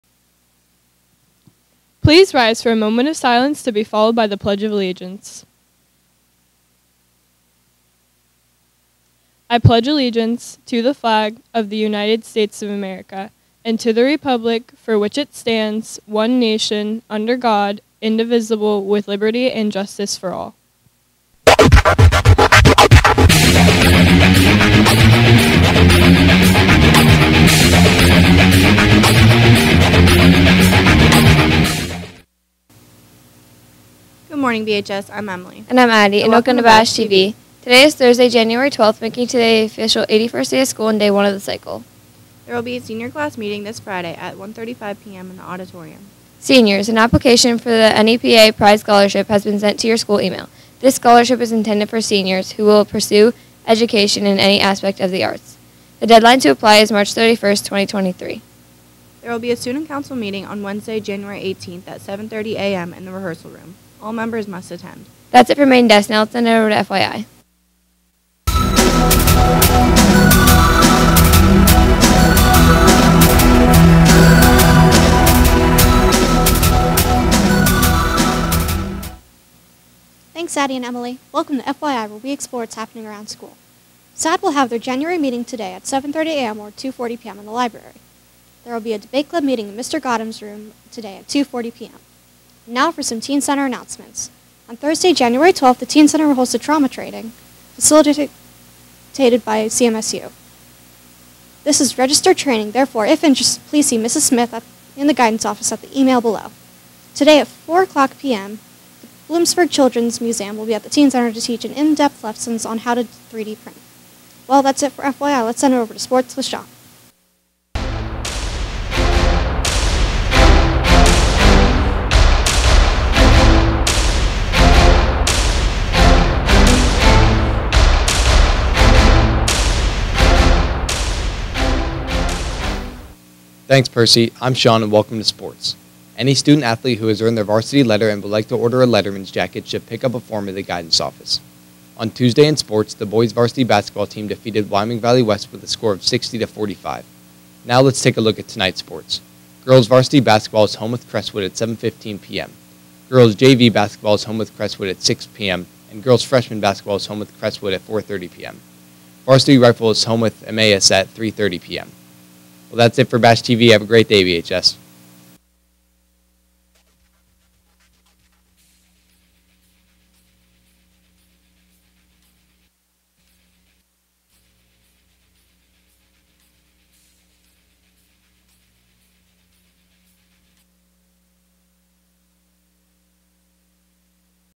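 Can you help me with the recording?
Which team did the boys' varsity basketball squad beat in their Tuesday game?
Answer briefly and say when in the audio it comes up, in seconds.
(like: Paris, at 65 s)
Wyoming Valley West, at 144 s.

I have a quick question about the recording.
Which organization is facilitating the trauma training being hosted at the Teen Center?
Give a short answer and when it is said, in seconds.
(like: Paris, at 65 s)
CMSU, at 99 s.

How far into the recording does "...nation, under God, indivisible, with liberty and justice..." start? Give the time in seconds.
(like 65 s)
16 s.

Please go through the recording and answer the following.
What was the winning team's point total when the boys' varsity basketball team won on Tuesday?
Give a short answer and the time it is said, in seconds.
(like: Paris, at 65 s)
60, at 146 s.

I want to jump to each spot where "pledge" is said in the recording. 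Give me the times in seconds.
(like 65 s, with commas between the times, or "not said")
4 s, 9 s.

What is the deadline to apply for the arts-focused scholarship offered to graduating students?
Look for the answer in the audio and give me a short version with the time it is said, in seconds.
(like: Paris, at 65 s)
March 31st, 2023, at 56 s.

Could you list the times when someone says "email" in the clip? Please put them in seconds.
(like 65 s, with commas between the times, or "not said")
50 s, 105 s.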